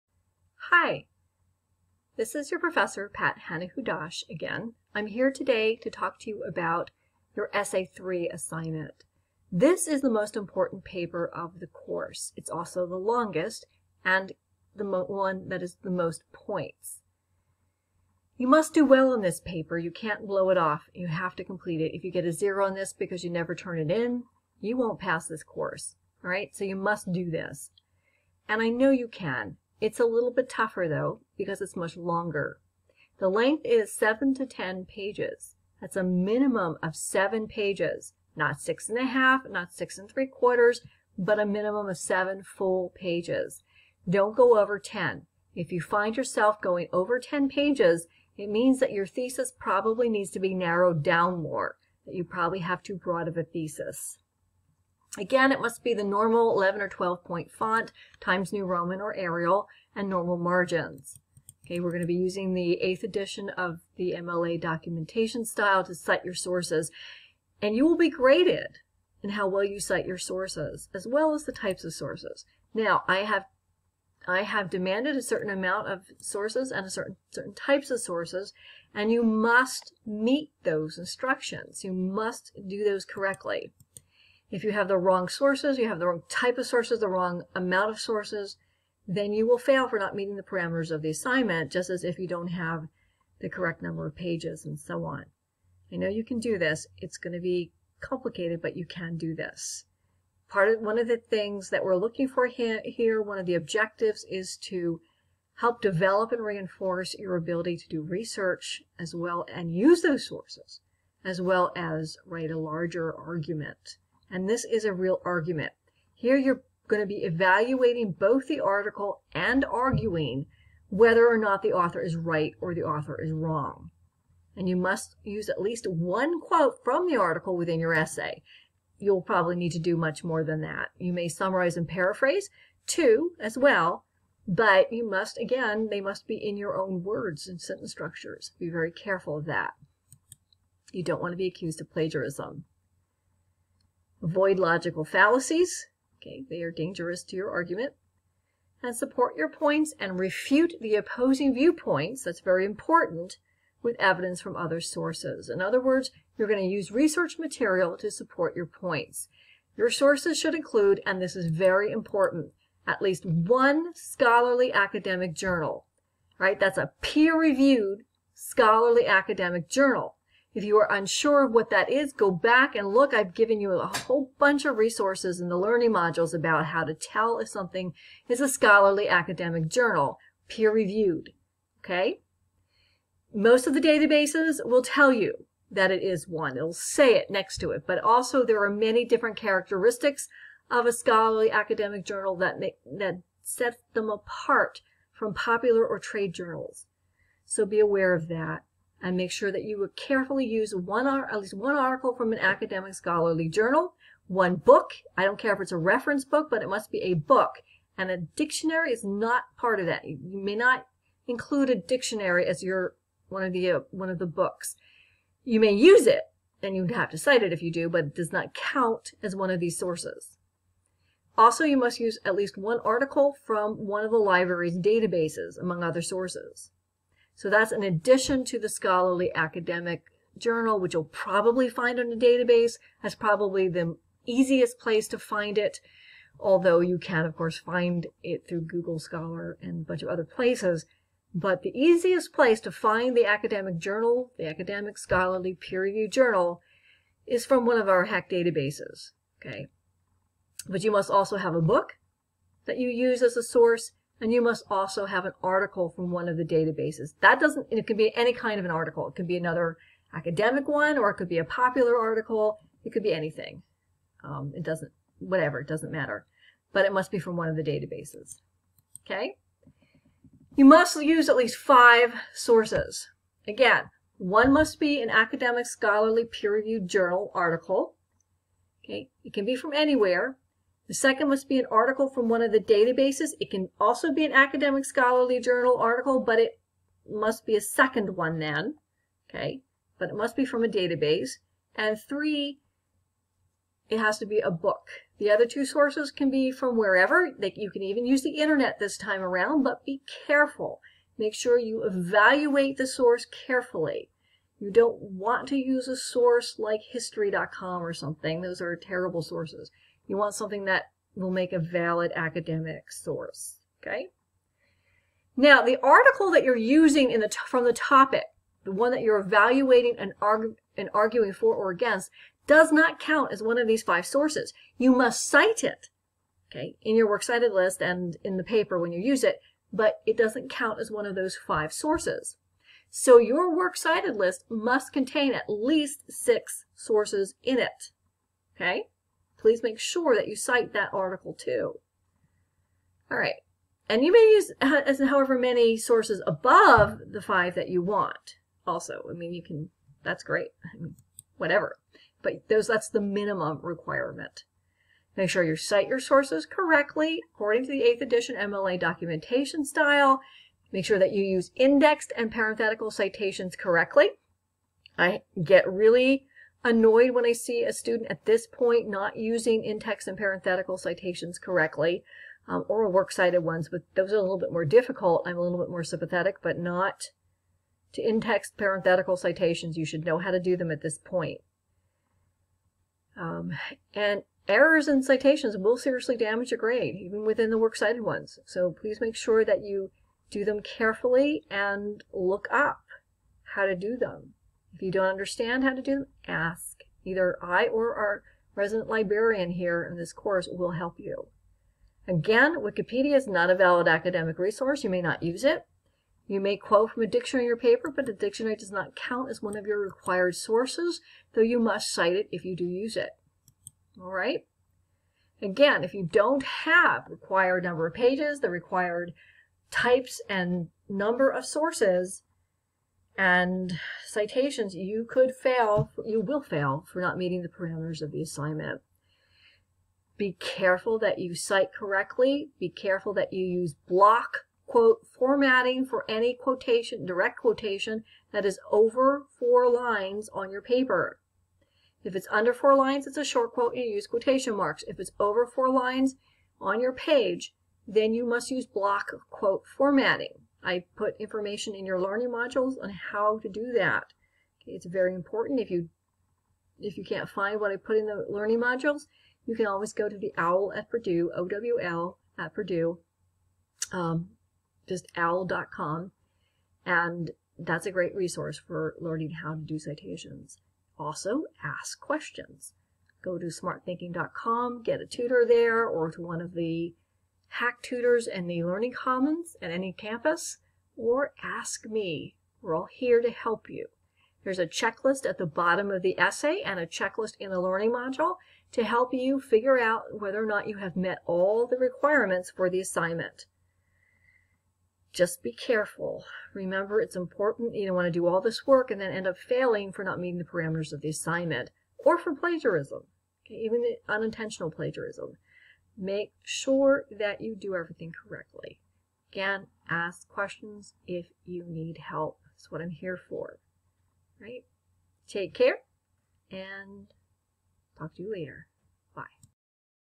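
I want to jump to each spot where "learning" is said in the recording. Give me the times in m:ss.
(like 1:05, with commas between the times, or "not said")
2:55, 7:31, 7:38, 7:48, 7:58, 8:07.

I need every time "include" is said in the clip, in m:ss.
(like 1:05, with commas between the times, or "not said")
2:40, 3:31.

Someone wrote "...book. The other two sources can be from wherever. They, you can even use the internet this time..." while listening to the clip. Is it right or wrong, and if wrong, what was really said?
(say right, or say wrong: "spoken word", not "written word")
right.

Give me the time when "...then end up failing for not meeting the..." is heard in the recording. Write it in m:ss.
8:19.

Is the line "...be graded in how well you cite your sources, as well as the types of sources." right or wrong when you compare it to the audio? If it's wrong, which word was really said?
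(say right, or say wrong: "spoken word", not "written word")
right.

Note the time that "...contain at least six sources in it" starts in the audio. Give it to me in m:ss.
5:34.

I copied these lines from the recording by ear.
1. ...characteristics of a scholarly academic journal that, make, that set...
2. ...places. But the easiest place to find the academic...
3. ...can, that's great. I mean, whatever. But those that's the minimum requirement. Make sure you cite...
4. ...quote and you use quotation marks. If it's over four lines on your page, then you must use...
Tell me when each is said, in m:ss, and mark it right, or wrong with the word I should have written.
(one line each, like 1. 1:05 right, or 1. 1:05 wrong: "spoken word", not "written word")
1. 3:09 right
2. 4:00 right
3. 5:49 right
4. 7:23 right.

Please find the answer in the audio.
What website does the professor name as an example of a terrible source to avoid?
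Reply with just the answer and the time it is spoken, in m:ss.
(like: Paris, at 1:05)
history.com, at 5:06.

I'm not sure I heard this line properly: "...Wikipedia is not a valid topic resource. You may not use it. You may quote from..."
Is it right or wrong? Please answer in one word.
wrong.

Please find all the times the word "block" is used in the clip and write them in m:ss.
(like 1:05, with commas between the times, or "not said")
7:13, 7:28.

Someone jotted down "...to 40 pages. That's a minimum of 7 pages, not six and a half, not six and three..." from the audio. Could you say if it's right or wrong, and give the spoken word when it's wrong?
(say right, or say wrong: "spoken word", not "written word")
wrong: "10", not "40".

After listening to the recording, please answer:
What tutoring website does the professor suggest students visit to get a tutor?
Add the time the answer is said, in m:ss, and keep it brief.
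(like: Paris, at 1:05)
smarthinking.com, at 7:53.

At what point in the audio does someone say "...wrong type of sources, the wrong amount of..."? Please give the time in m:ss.
1:26.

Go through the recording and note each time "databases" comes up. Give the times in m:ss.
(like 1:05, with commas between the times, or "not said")
3:03, 3:44, 3:52, 4:08, 4:16, 4:27, 4:42, 4:50.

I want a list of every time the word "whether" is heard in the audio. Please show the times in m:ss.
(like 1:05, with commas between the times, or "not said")
2:00, 8:10.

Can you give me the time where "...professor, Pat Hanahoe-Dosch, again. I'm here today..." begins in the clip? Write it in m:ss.
0:02.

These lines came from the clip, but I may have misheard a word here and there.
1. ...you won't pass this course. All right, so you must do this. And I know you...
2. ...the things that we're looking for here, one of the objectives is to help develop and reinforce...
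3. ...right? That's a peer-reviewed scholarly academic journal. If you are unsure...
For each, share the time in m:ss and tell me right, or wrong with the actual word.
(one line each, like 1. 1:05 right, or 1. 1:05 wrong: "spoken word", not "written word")
1. 0:24 right
2. 1:41 right
3. 2:46 right.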